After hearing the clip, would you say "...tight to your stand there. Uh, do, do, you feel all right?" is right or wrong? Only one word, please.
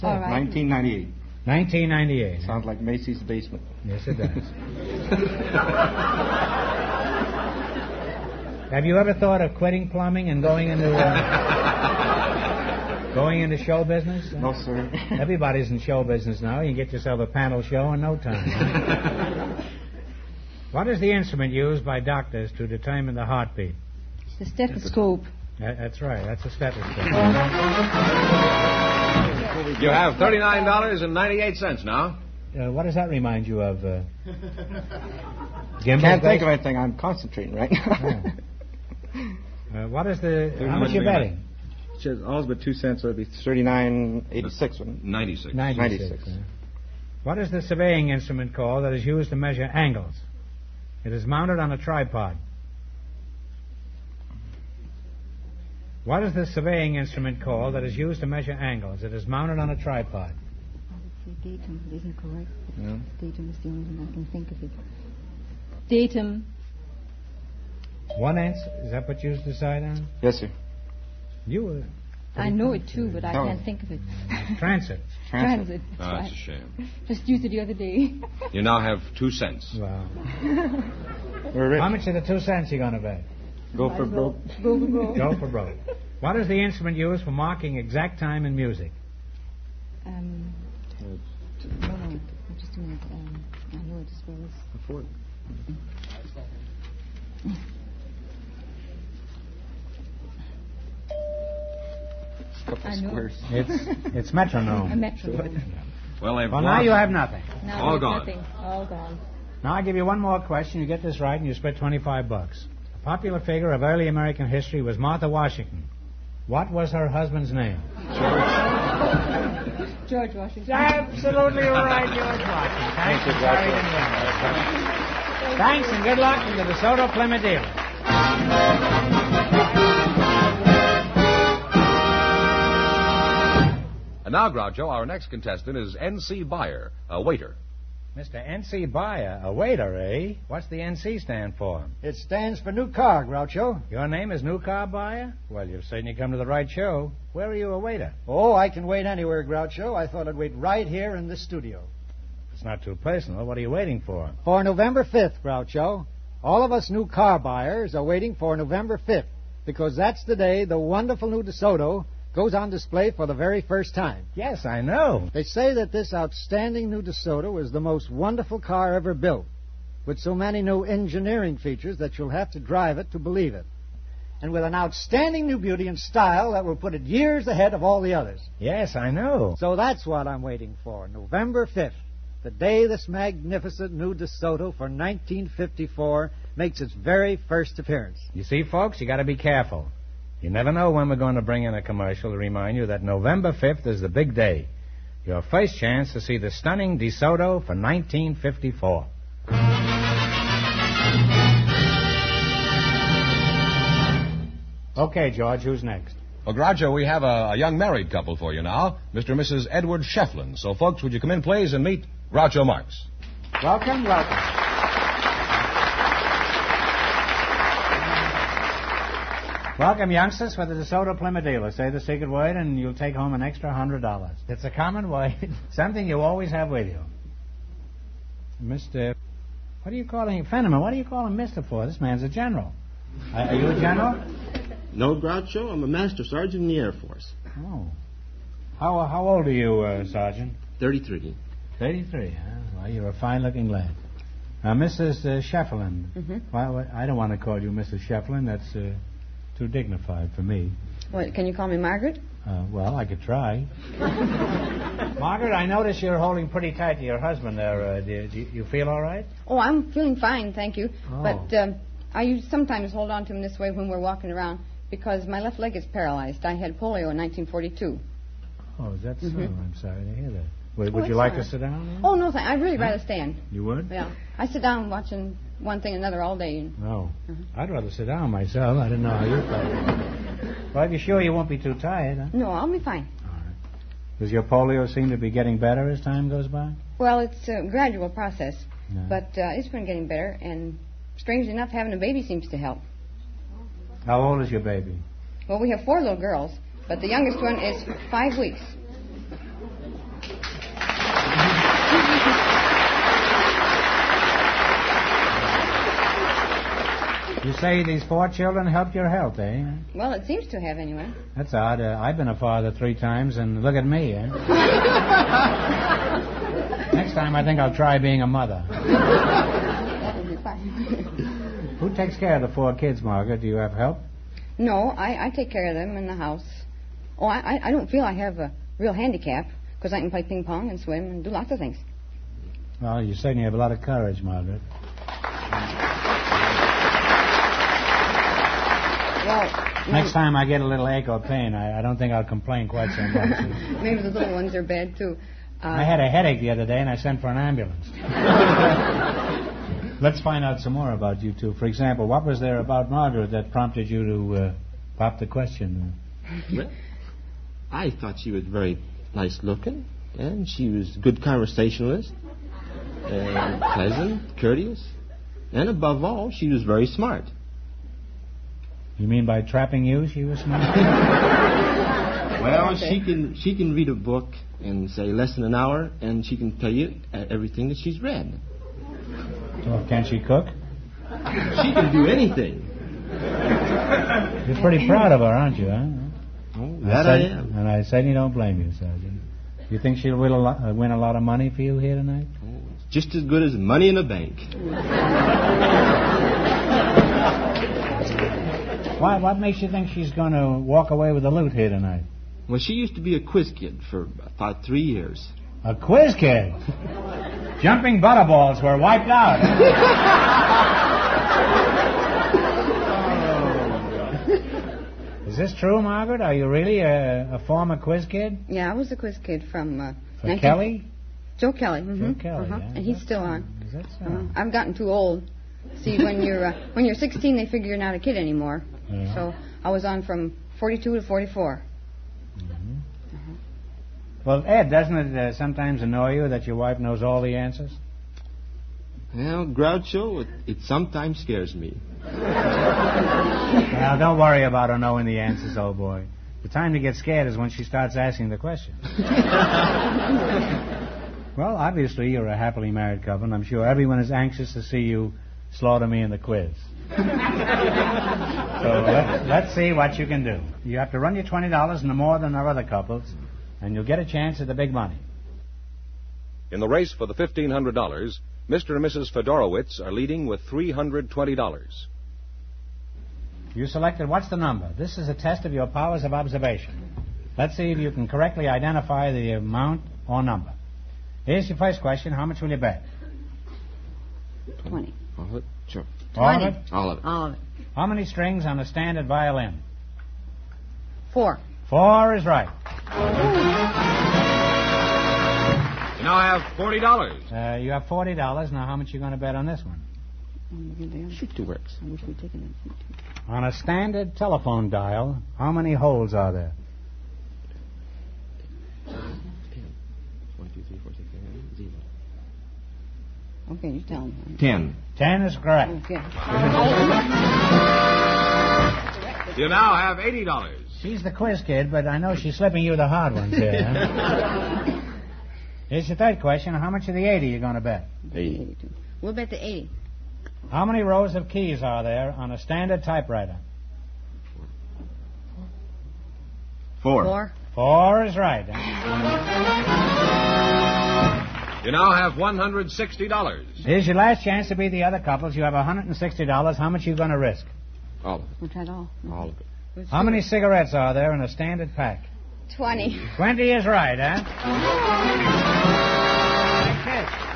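wrong.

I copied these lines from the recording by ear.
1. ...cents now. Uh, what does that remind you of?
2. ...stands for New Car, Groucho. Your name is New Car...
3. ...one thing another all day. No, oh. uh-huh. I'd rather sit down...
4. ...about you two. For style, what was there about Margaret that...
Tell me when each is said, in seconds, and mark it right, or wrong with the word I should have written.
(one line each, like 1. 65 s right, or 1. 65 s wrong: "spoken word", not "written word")
1. 31 s right
2. 142 s right
3. 275 s right
4. 350 s wrong: "example", not "style".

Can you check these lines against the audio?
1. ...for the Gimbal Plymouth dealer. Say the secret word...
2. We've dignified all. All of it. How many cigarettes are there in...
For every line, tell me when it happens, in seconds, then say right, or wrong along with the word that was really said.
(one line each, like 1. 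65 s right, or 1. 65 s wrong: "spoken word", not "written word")
1. 220 s wrong: "DeSoto", not "Gimbal"
2. 548 s wrong: "tried", not "dignified".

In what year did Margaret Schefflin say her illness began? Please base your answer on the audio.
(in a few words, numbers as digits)
1942.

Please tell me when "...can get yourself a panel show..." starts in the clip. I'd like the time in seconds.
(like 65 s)
16 s.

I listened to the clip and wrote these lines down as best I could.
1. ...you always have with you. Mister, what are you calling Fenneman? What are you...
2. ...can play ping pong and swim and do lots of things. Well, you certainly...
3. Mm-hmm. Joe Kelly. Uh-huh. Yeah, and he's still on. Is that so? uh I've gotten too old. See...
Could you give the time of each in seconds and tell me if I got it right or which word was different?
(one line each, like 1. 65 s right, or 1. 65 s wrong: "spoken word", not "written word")
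1. 226 s right
2. 330 s right
3. 421 s right.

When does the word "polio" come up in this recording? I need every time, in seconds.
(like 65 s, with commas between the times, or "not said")
266 s, 284 s.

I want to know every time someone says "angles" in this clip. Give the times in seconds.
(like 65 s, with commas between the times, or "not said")
49 s, 58 s.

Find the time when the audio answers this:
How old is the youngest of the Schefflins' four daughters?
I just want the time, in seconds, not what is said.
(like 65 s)
296 s.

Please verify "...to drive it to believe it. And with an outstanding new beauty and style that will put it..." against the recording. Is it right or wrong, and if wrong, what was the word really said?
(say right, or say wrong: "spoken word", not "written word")
right.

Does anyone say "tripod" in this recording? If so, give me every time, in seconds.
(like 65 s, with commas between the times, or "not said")
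51 s, 59 s.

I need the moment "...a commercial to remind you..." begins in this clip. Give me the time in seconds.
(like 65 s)
191 s.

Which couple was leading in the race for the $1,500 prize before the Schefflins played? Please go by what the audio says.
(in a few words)
Mr. and Mrs. Fedorowicz.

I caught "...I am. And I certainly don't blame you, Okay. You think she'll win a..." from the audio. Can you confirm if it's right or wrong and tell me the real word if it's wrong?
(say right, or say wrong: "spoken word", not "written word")
wrong: "Sergeant", not "Okay".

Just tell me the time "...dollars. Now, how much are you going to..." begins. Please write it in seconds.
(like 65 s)
498 s.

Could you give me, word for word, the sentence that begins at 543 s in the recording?
Here's your last chance to beat the other couples.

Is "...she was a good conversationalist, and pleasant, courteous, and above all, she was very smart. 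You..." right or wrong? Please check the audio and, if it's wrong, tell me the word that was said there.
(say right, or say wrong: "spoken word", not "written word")
right.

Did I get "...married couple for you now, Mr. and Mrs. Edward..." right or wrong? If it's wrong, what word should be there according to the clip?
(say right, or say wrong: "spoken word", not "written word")
right.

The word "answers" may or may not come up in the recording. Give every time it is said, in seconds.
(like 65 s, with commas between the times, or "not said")
68 s, 437 s, 445 s.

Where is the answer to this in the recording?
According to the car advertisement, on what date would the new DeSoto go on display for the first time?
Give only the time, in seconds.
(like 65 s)
154 s.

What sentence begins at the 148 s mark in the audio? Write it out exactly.
Oh, I can wait anywhere, Groucho.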